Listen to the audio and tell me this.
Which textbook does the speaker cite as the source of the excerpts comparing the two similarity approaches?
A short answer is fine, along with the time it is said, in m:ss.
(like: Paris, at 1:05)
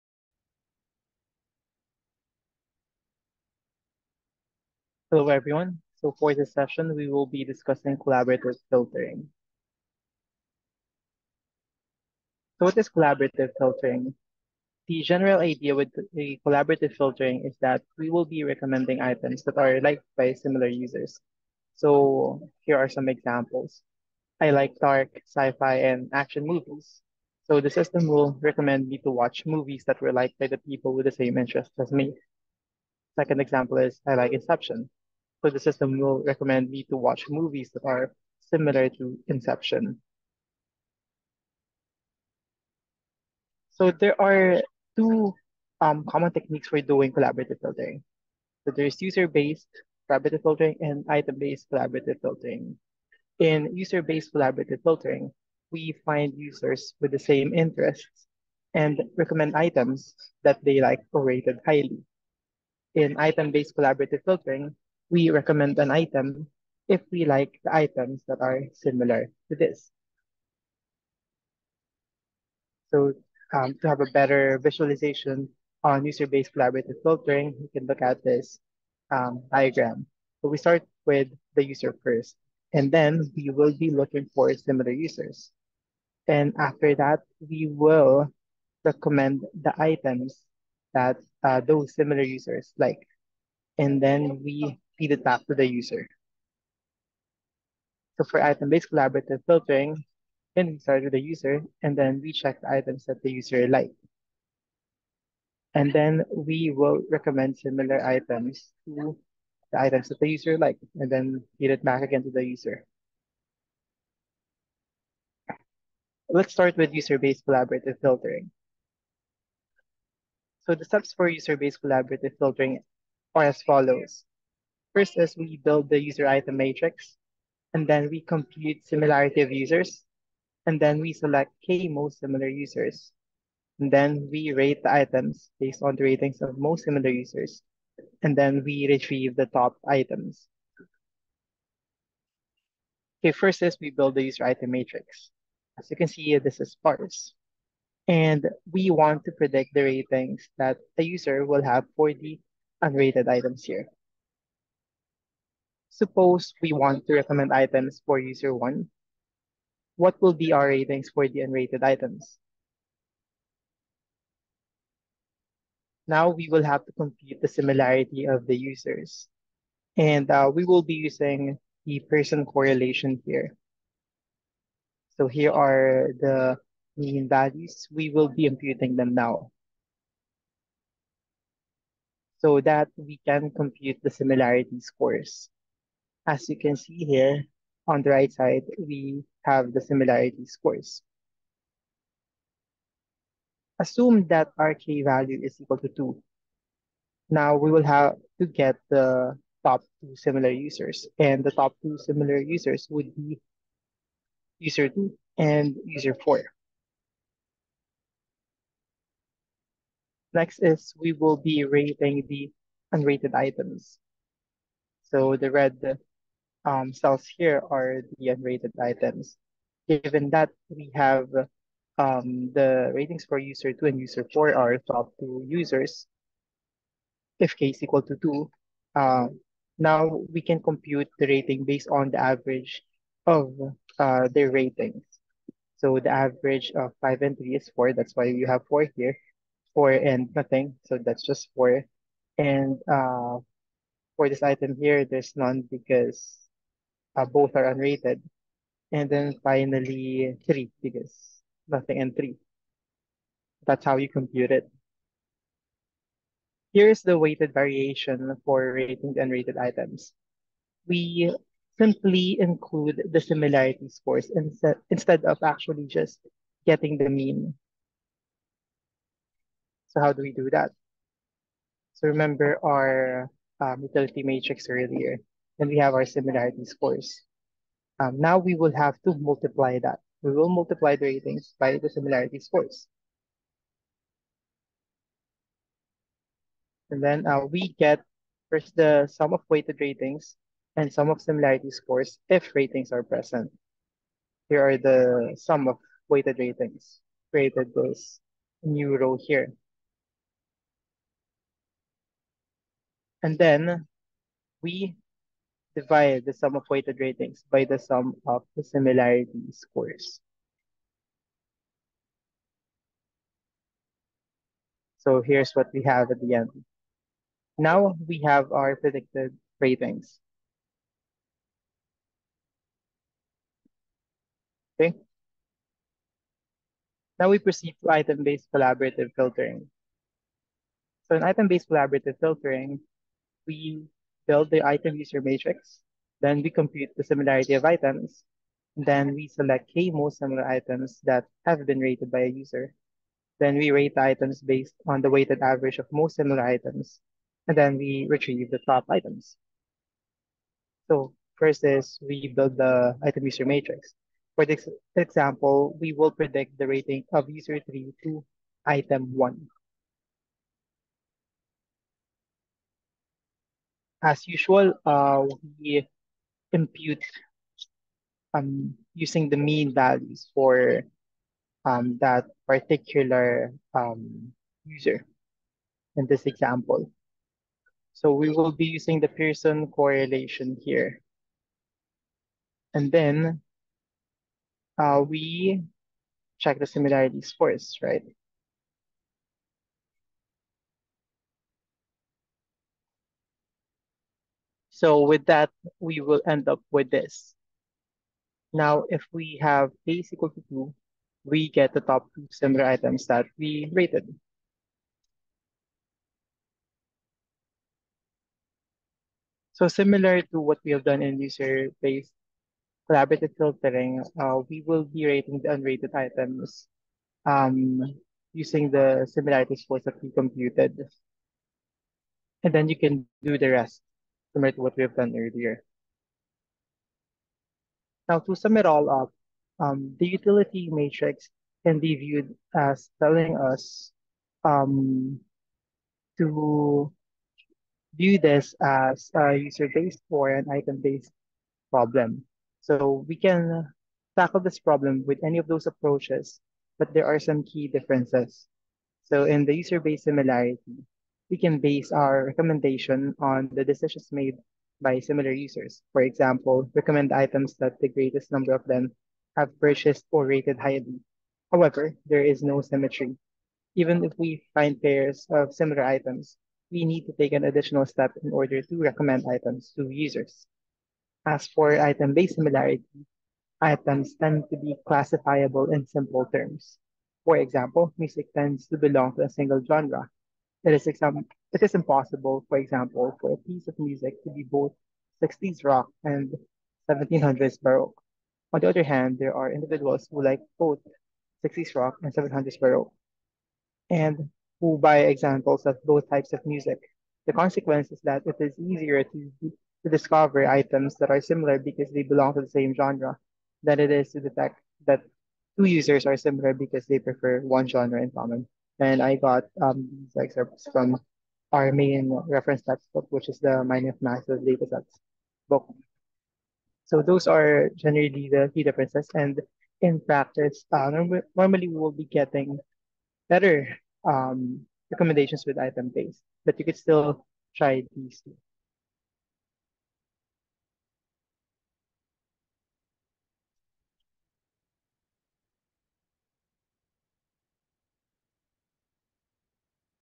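Mining of Massive Datasets, at 8:33.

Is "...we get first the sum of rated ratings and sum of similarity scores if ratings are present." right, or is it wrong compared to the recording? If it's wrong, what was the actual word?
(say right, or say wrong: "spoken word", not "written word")
wrong: "weighted", not "rated".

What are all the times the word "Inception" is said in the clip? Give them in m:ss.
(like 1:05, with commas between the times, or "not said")
0:34, 0:39.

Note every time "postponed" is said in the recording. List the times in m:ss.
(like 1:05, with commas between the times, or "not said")
not said.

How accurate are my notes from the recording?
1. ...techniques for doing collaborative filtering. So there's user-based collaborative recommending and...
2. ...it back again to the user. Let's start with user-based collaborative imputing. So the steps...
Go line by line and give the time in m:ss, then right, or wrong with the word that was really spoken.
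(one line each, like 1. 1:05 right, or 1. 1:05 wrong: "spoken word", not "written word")
1. 0:46 wrong: "filtering", not "recommending"
2. 1:51 wrong: "filtering", not "imputing".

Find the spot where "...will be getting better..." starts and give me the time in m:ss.
8:41.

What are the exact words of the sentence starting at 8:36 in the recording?
So those are generally the key differences.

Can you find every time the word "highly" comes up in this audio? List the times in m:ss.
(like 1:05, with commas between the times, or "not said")
1:01, 7:40.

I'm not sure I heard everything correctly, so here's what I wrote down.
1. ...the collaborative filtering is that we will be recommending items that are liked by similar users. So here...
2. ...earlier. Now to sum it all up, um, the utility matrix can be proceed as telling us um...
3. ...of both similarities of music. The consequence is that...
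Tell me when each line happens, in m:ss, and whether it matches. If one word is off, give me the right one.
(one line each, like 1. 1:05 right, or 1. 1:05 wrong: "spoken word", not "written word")
1. 0:16 right
2. 7:05 wrong: "viewed", not "proceed"
3. 8:15 wrong: "types", not "similarities".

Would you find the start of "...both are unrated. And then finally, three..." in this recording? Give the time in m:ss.
4:07.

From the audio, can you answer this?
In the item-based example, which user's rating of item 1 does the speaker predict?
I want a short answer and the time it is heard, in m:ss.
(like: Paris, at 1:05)
User 3, at 5:57.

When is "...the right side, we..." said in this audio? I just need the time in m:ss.
3:08.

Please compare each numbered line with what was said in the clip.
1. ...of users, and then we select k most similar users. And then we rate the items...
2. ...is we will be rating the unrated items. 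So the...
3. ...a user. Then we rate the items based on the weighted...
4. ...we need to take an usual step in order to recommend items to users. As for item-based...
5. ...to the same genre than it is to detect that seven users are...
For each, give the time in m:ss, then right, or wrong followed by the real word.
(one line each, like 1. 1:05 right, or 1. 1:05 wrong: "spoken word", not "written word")
1. 2:09 right
2. 3:30 right
3. 5:42 right
4. 7:46 wrong: "additional", not "usual"
5. 8:22 wrong: "two", not "seven".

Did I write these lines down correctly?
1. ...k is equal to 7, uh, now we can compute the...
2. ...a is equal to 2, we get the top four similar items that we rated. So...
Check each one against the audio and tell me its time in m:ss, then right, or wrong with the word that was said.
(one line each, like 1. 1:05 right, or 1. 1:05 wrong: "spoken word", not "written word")
1. 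3:47 wrong: "2", not "7"
2. 6:39 wrong: "two", not "four".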